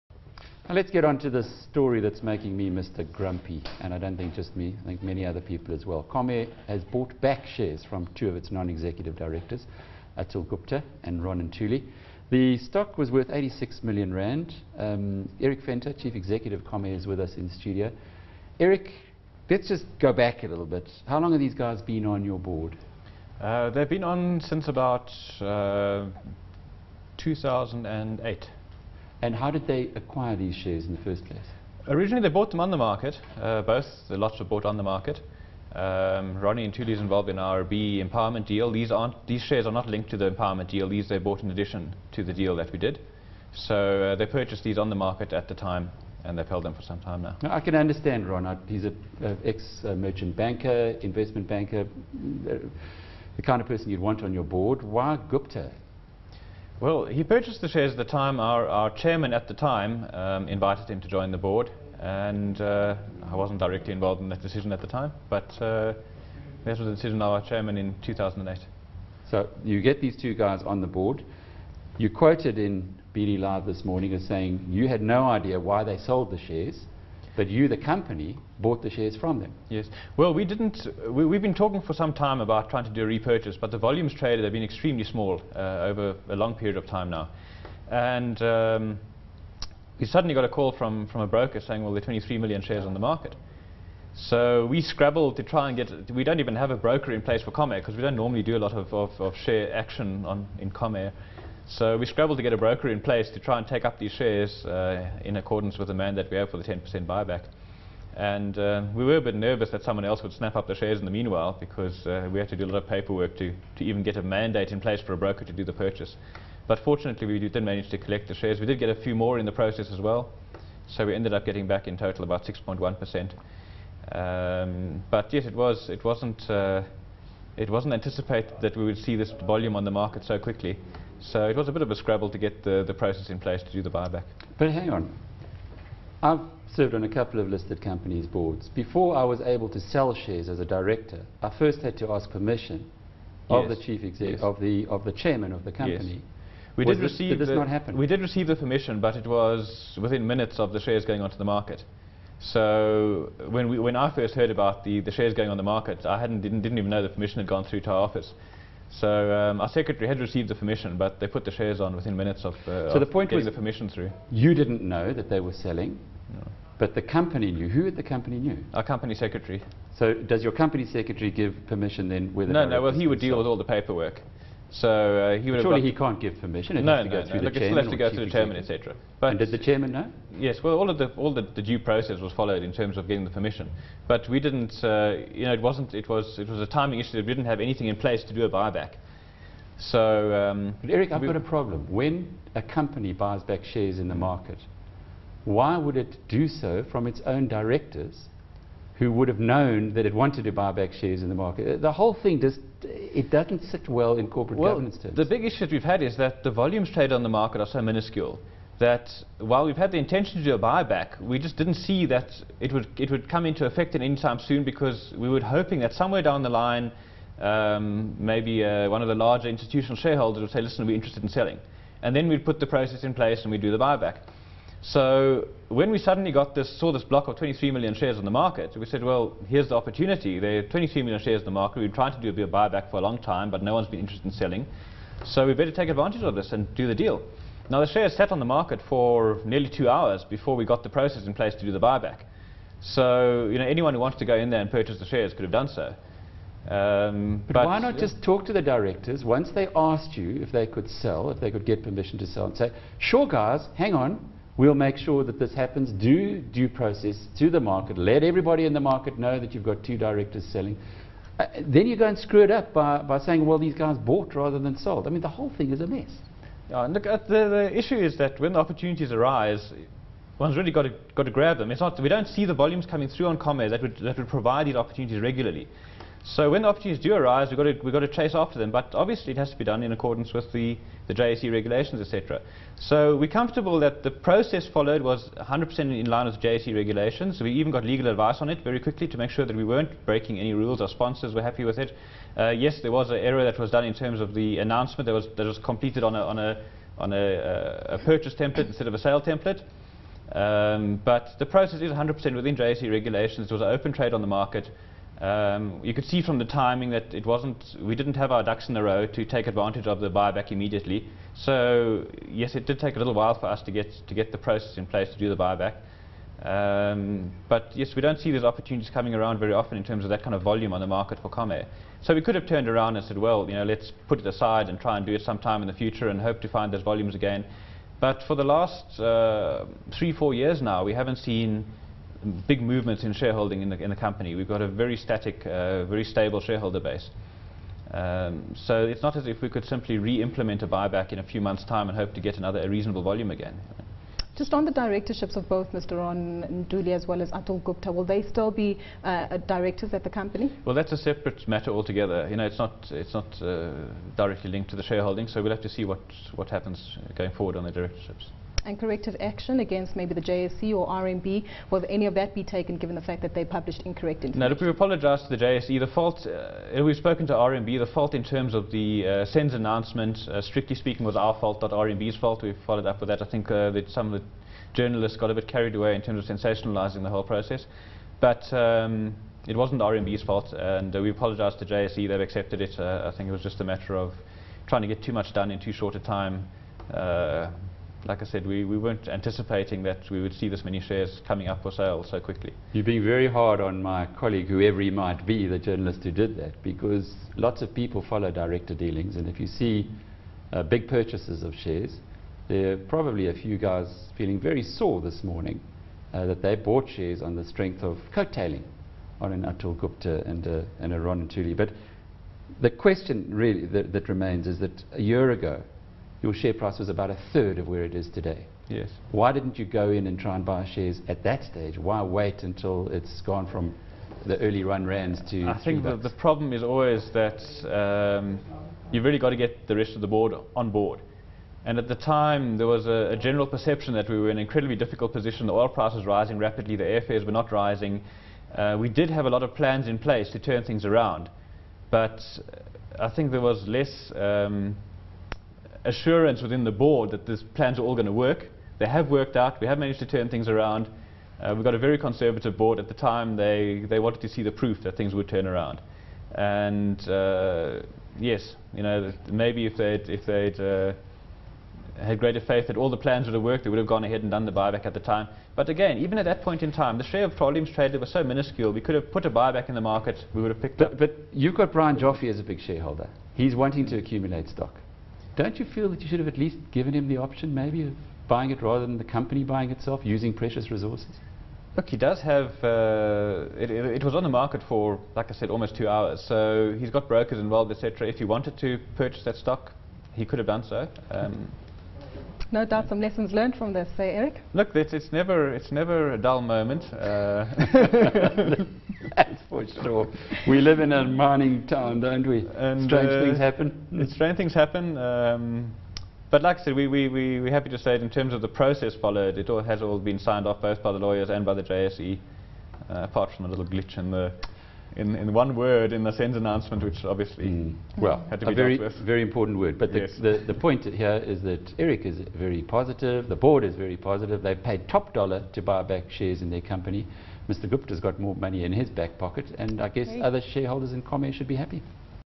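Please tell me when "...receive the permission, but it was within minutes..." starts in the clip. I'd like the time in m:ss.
2:28.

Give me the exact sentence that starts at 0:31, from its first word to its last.
Originally, they bought them on the market, uh, both.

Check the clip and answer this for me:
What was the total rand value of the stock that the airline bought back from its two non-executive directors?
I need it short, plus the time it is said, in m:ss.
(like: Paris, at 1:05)
86 million rand, at 0:13.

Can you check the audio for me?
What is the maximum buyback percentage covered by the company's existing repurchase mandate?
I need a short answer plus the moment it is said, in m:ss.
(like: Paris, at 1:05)
10%, at 1:46.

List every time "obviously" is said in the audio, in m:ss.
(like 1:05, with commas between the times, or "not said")
4:38, 8:37.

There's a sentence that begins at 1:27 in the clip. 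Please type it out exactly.
And um, we suddenly got a call from, from a broker saying, well, there are 23 million shares on the market.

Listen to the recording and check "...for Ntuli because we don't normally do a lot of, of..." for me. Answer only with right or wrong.
wrong.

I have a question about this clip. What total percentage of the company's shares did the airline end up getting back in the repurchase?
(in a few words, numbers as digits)
6.1%.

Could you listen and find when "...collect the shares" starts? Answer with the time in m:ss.
1:57.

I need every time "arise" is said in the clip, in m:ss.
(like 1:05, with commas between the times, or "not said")
4:29, 4:37.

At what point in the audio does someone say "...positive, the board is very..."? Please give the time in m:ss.
8:42.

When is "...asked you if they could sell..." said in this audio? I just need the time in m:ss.
4:09.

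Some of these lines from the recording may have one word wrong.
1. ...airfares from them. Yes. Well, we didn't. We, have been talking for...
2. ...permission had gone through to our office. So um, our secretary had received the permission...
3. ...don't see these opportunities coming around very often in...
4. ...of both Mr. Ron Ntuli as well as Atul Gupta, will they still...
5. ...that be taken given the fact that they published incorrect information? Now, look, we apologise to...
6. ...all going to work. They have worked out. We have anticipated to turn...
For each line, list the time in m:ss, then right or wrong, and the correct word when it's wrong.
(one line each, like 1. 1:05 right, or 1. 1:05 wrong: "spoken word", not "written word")
1. 1:18 wrong: "shares", not "airfares"
2. 2:37 right
3. 5:18 right
4. 5:45 right
5. 6:02 right
6. 7:27 wrong: "managed", not "anticipated".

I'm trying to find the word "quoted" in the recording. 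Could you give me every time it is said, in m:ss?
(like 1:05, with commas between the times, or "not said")
1:12.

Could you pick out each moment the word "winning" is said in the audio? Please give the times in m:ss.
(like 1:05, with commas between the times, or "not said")
not said.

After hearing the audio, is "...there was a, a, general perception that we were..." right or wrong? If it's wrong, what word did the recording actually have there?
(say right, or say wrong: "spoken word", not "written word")
right.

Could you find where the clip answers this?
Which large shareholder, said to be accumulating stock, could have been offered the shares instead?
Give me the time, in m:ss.
7:51.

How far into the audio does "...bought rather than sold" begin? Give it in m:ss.
4:23.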